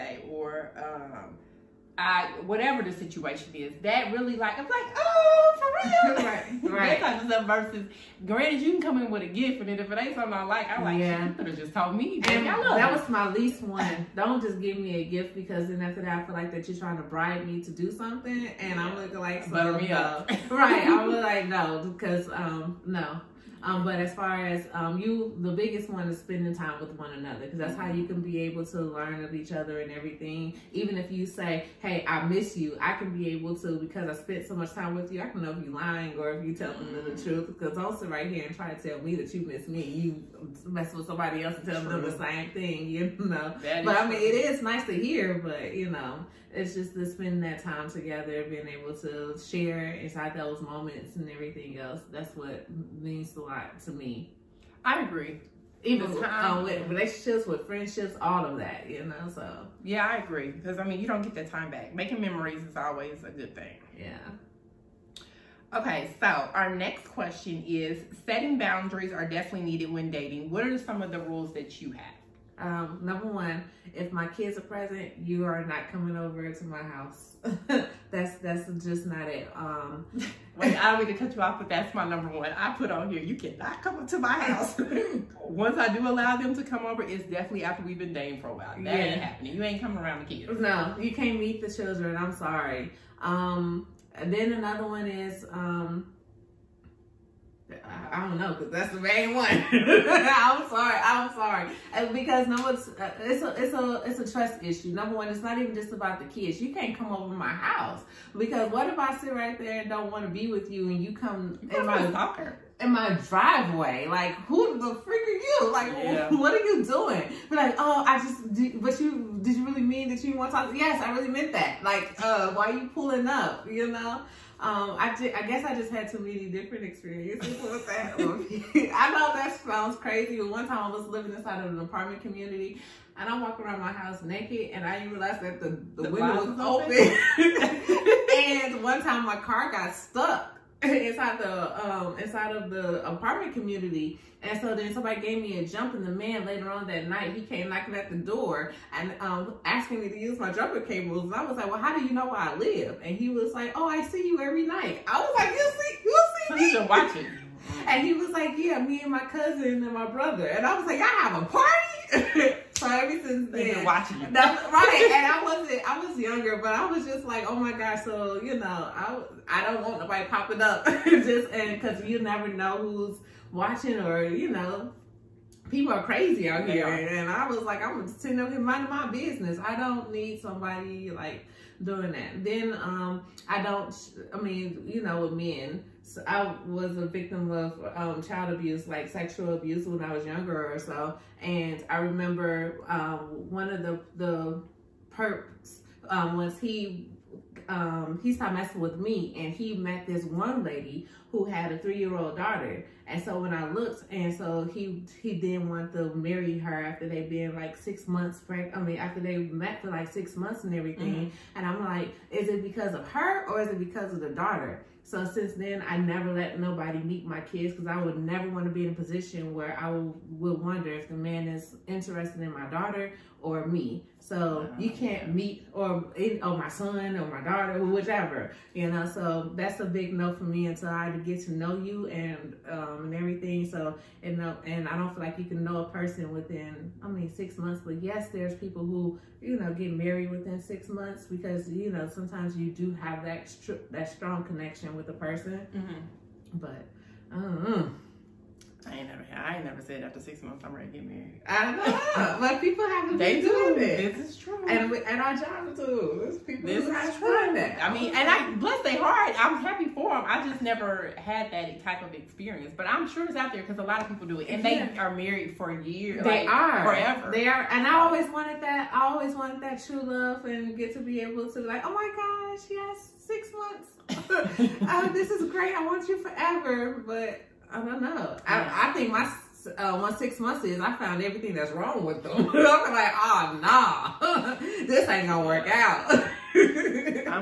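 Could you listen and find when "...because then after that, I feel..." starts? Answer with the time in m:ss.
0:15.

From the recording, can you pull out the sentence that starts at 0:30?
Even if you say, "Hey, I miss you," I can be able to because I spent so much time with you.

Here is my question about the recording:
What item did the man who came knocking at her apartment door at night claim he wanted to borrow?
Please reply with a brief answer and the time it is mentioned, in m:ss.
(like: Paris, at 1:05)
Jumper cables, at 2:30.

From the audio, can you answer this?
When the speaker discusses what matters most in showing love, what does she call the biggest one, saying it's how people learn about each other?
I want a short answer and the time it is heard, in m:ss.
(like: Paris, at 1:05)
Spending time, at 0:26.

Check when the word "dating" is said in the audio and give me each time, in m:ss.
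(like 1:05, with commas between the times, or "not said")
1:10, 1:28.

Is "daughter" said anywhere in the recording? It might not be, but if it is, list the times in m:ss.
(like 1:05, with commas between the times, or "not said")
3:22, 3:34, 3:42, 3:47.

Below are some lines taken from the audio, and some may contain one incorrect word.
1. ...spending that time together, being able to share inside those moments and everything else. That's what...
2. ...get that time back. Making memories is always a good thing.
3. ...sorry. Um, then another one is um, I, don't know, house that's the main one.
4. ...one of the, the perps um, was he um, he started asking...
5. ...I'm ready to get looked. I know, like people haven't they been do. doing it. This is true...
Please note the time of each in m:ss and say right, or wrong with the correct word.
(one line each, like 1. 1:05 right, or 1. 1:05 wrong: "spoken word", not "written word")
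1. 0:47 right
2. 1:01 right
3. 1:32 wrong: "cause", not "house"
4. 3:13 wrong: "messing", not "asking"
5. 4:10 wrong: "married", not "looked".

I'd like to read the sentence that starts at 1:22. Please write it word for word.
I put on here, you cannot come up to my house.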